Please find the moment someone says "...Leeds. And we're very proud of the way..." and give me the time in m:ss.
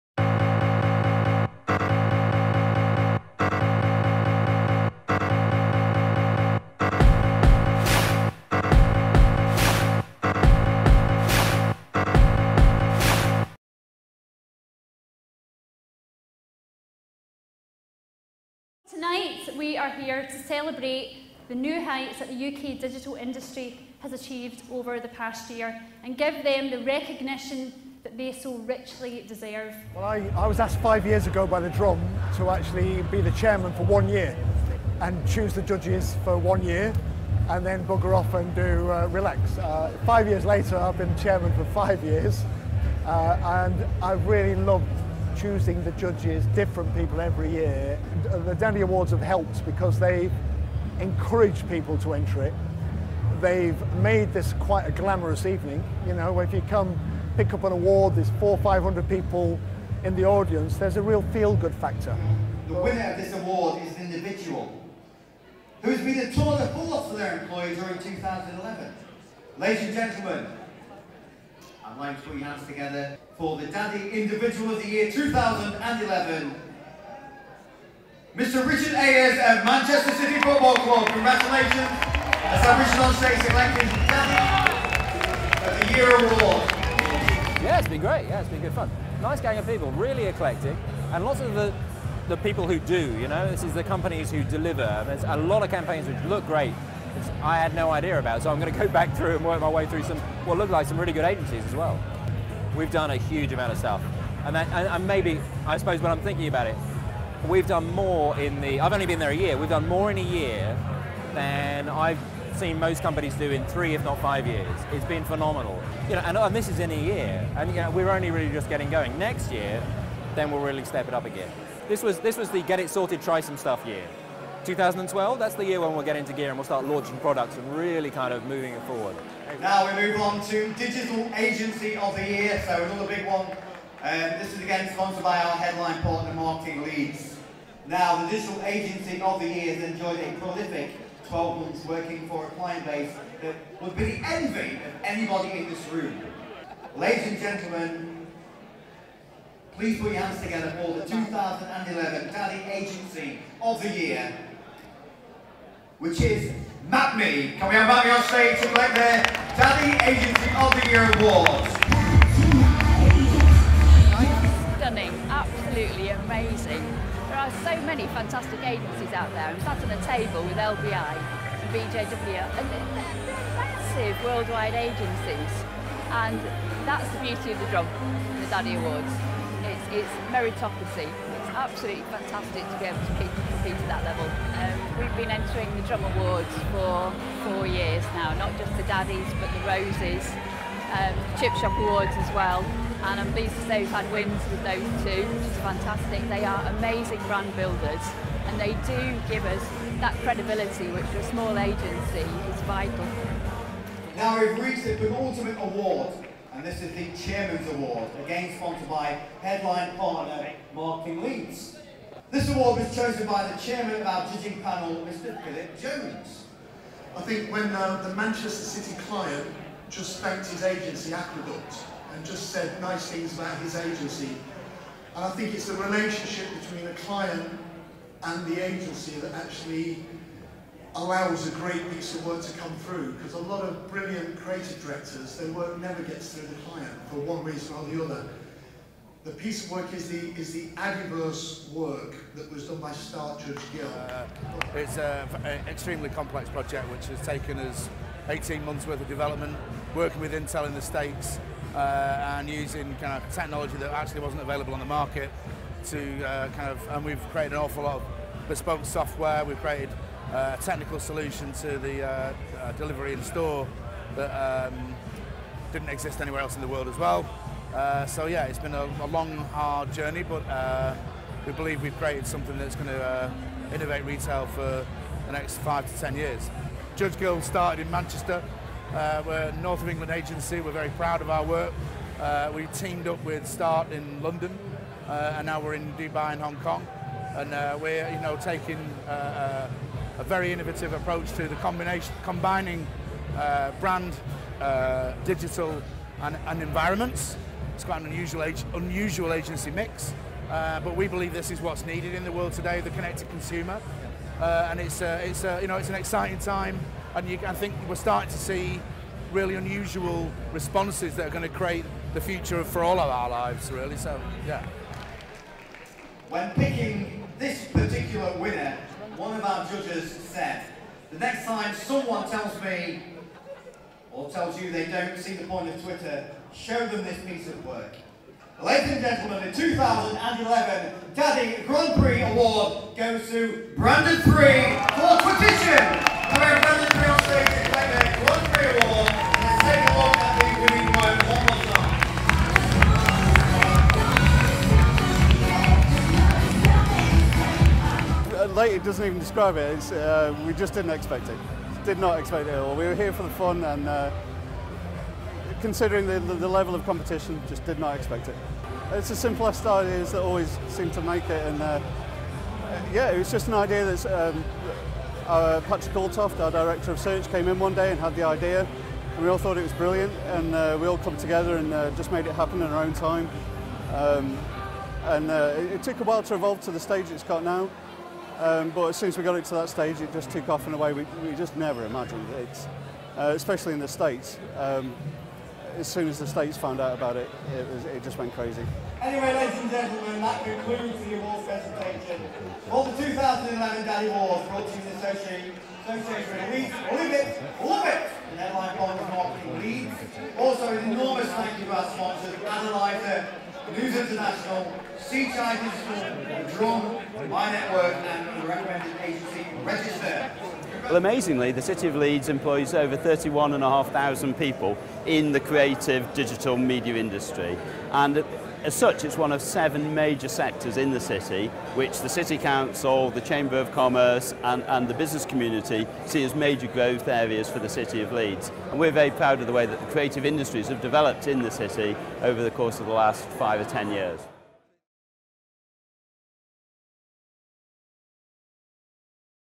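7:08.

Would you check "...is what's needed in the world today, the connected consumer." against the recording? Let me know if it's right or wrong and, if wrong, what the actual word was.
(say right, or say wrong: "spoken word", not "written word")
right.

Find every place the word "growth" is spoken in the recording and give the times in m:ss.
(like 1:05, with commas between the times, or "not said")
7:06.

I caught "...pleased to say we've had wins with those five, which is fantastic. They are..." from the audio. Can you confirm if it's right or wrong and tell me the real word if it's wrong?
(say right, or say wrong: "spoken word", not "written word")
wrong: "two", not "five".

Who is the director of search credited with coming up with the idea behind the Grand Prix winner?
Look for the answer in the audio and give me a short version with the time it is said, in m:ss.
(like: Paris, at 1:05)
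Patrick Altoft, at 6:05.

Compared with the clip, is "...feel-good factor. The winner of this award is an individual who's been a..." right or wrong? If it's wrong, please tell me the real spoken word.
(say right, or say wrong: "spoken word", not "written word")
right.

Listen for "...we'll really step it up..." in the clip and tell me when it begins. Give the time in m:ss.
2:00.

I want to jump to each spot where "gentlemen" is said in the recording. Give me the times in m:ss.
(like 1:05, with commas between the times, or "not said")
1:09, 2:27, 5:29, 6:29.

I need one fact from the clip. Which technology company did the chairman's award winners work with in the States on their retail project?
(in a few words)
Intel.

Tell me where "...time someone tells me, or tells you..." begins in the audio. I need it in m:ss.
5:21.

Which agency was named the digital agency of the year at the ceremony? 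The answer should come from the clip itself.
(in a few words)
Map Me.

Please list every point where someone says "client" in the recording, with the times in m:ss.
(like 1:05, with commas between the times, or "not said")
2:22, 3:39, 3:47, 3:56.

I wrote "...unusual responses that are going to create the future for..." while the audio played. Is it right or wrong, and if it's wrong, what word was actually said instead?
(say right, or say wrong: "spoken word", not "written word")
right.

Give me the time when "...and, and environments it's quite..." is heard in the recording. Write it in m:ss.
4:56.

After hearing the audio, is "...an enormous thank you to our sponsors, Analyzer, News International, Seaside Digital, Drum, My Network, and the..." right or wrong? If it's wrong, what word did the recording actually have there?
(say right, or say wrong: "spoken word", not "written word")
right.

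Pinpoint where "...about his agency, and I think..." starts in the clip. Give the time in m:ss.
3:43.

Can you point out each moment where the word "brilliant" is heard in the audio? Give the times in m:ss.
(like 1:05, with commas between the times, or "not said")
3:53, 6:09.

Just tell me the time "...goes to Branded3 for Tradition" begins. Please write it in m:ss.
5:32.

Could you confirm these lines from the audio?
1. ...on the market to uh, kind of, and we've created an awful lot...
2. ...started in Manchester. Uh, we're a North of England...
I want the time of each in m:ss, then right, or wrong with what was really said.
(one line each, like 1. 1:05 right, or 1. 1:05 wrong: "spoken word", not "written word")
1. 4:14 right
2. 4:37 right.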